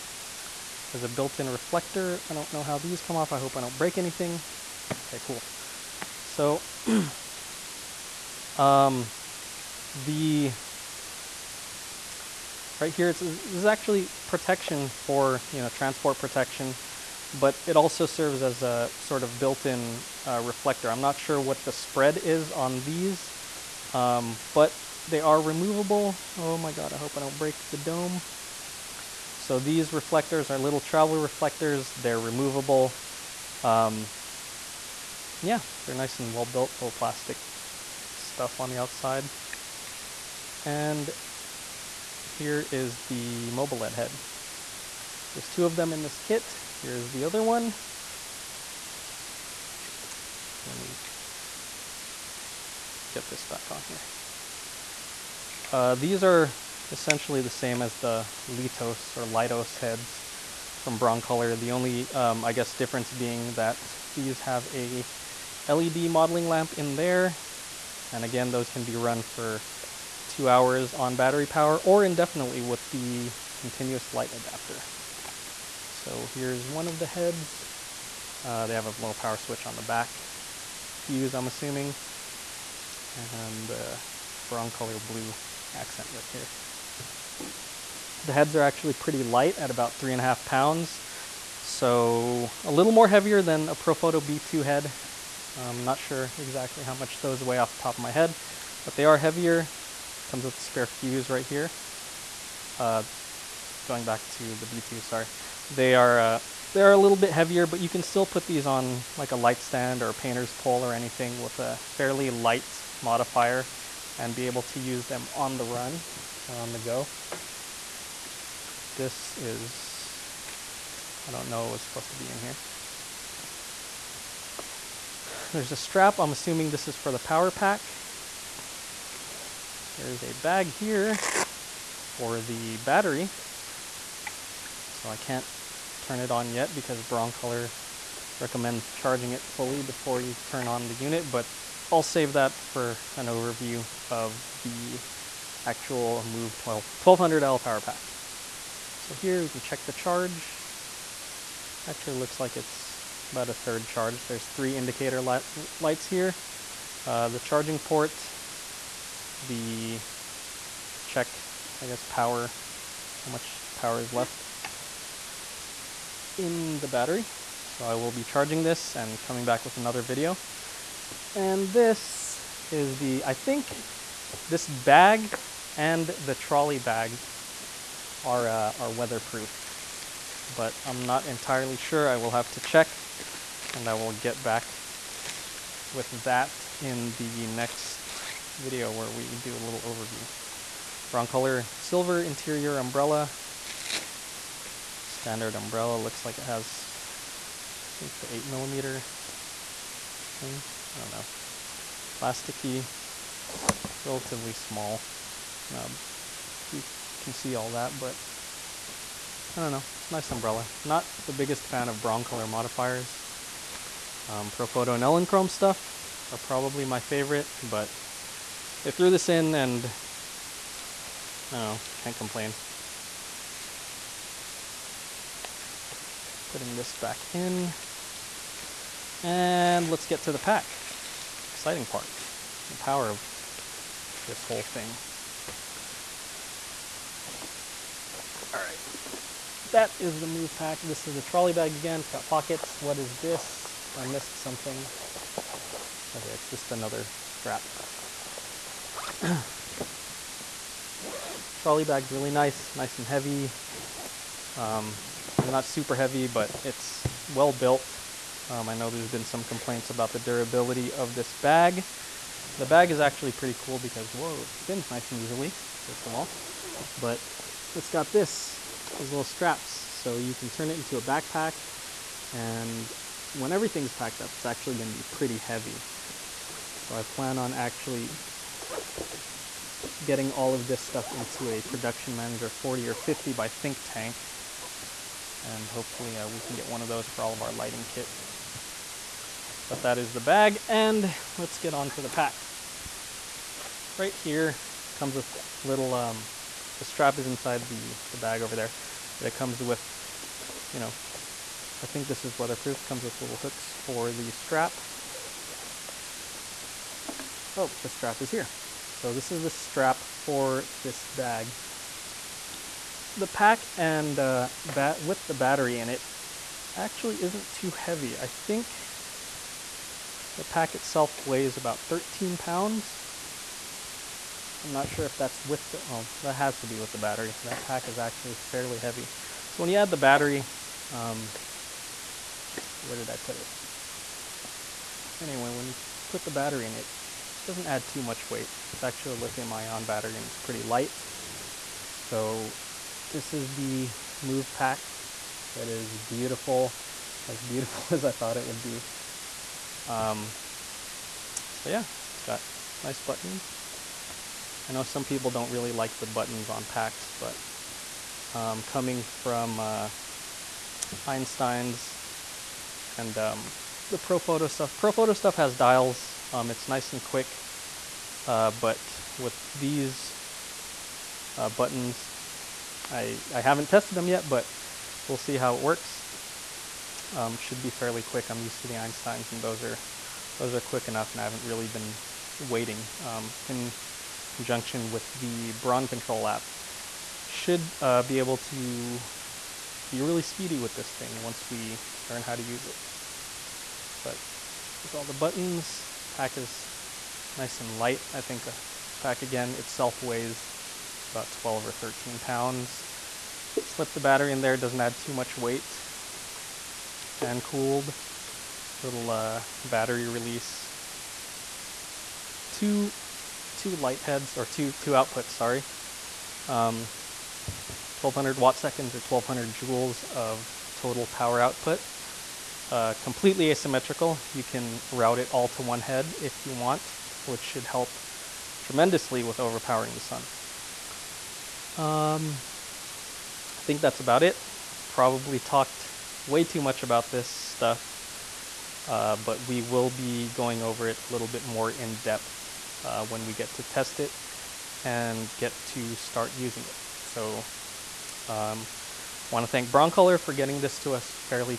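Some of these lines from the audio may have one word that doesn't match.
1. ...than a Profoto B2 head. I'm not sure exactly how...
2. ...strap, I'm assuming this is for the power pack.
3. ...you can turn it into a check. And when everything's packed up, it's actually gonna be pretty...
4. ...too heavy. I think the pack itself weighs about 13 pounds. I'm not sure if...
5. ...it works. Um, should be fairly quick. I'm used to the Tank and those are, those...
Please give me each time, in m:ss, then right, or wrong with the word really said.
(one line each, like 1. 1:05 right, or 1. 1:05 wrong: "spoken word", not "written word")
1. 1:33 right
2. 2:05 right
3. 4:30 wrong: "backpack", not "check"
4. 5:17 right
5. 6:15 wrong: "Einsteins", not "Tank".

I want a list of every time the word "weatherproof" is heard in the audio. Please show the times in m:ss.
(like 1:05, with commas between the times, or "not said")
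2:58, 5:02.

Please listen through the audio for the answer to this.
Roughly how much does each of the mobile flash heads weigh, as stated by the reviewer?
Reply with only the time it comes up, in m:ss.
1:29.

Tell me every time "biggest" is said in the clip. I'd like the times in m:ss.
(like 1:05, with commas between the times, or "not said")
3:31.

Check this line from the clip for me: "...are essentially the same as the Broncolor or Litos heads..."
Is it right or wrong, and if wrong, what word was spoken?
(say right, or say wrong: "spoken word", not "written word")
wrong: "Litos", not "Broncolor".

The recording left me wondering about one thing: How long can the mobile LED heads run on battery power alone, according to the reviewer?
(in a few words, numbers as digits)
2 hours.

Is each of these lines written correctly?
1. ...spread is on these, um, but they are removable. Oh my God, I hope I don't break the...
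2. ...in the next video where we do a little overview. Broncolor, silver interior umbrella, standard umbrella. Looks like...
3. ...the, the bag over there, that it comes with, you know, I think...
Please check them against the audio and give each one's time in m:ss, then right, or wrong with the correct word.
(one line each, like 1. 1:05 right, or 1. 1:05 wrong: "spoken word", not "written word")
1. 0:21 right
2. 3:06 right
3. 4:57 right.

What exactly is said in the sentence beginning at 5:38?
It's actually a lithium ion battery and it's pretty light.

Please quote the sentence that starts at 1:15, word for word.
So here's one of the heads.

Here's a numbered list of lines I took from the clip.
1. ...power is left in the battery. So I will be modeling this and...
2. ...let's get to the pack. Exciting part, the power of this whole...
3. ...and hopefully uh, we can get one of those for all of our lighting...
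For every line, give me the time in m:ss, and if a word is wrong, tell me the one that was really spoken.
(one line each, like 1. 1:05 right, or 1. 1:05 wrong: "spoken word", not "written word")
1. 2:43 wrong: "charging", not "modeling"
2. 3:49 right
3. 4:45 right.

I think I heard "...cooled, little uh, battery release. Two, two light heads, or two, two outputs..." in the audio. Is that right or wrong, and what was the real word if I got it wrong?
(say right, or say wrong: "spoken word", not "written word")
right.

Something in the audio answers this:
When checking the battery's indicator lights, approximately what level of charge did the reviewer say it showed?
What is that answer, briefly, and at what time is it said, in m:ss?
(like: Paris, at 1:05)
about a third, at 2:33.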